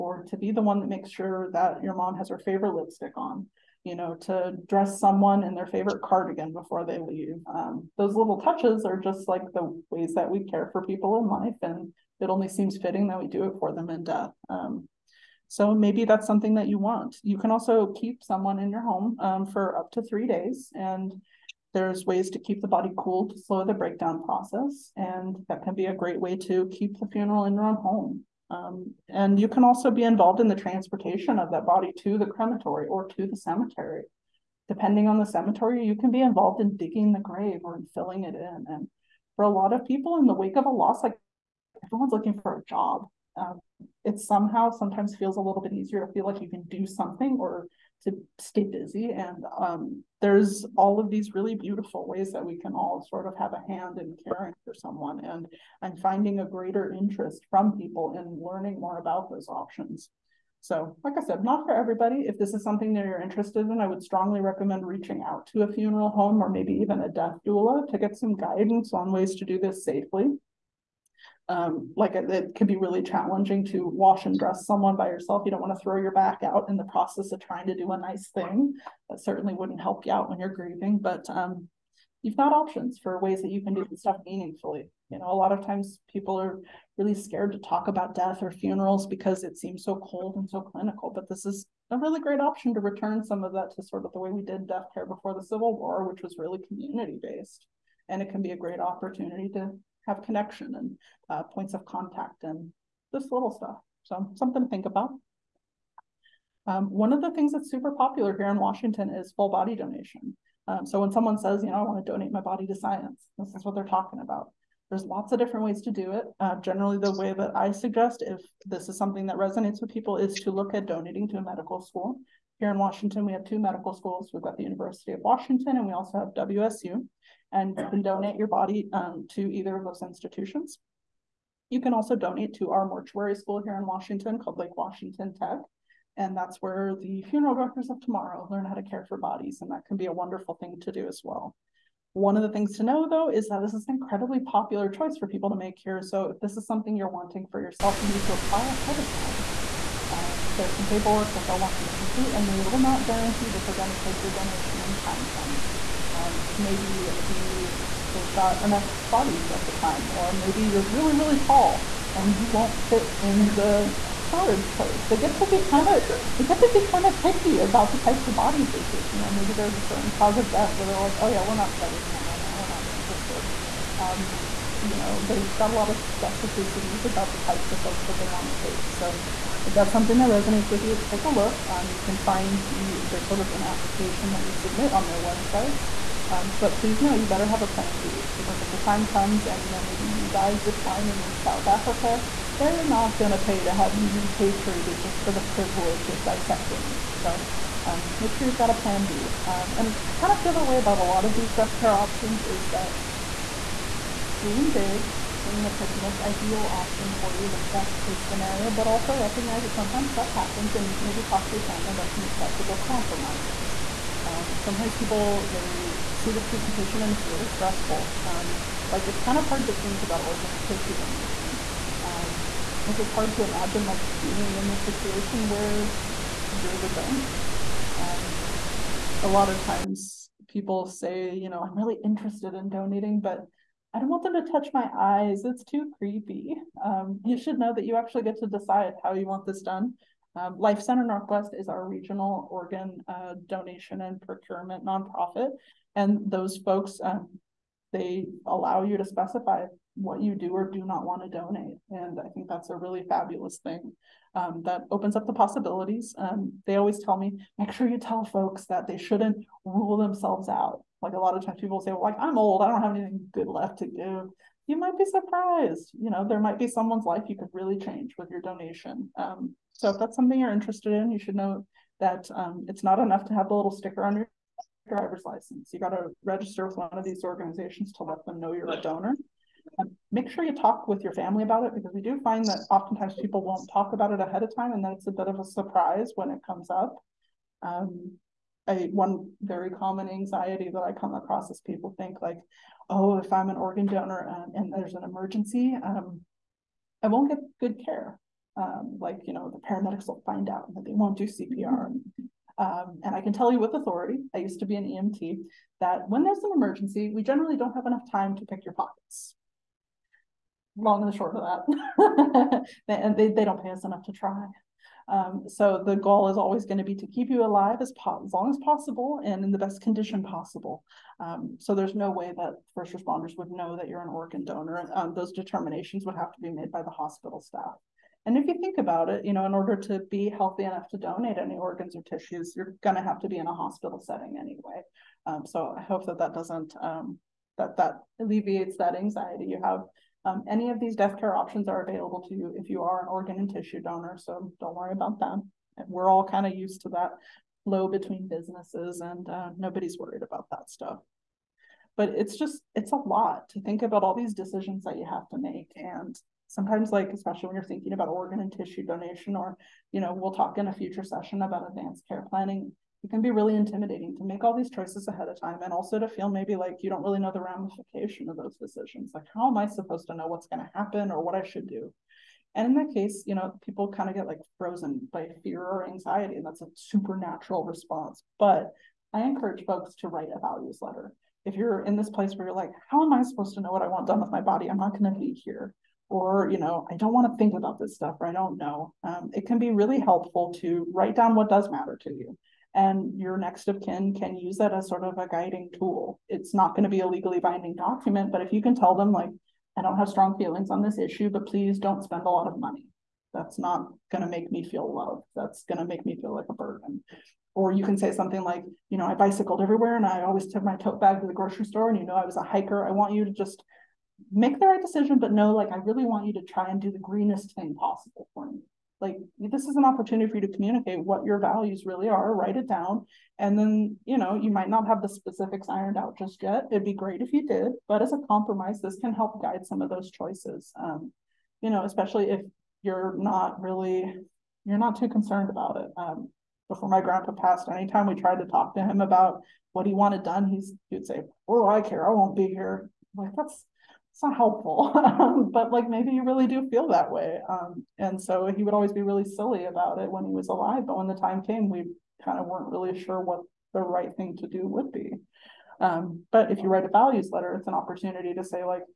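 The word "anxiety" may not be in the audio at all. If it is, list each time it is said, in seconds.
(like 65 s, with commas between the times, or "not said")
290 s, 338 s, 375 s.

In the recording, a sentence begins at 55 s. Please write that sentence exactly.
And I'm finding a greater interest from people in learning more about those options.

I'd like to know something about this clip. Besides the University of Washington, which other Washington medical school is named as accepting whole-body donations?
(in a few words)
WSU.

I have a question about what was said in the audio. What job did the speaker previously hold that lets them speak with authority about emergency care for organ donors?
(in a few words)
EMT.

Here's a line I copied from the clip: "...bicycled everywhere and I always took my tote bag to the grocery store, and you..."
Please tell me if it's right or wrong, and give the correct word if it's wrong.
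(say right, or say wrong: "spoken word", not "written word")
right.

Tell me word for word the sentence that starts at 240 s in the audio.
Um, Life Center Northwest is our regional organ uh, donation and procurement nonprofit.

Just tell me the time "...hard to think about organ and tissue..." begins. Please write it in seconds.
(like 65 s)
219 s.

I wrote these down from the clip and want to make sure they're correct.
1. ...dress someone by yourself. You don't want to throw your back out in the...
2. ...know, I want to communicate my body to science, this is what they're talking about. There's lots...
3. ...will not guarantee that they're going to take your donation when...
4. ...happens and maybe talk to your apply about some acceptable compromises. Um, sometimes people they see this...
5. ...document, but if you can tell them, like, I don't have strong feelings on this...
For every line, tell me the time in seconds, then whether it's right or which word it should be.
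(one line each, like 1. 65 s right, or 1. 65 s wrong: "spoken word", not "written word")
1. 74 s right
2. 111 s wrong: "donate", not "communicate"
3. 152 s right
4. 210 s wrong: "family", not "apply"
5. 397 s right.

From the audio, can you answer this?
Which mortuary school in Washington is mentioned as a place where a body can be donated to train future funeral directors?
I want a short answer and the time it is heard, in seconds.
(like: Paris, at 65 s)
Lake Washington Tech, at 134 s.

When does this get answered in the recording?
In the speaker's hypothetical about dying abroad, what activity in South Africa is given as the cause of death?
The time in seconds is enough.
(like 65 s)
190 s.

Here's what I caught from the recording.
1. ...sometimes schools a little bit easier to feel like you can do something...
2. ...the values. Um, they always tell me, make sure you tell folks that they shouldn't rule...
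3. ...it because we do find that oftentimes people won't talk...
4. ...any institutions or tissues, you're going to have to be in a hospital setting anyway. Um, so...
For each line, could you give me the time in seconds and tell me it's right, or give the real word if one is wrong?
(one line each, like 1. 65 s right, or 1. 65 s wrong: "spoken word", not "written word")
1. 44 s wrong: "feels", not "schools"
2. 255 s wrong: "possibilities", not "values"
3. 281 s right
4. 331 s wrong: "organs", not "institutions".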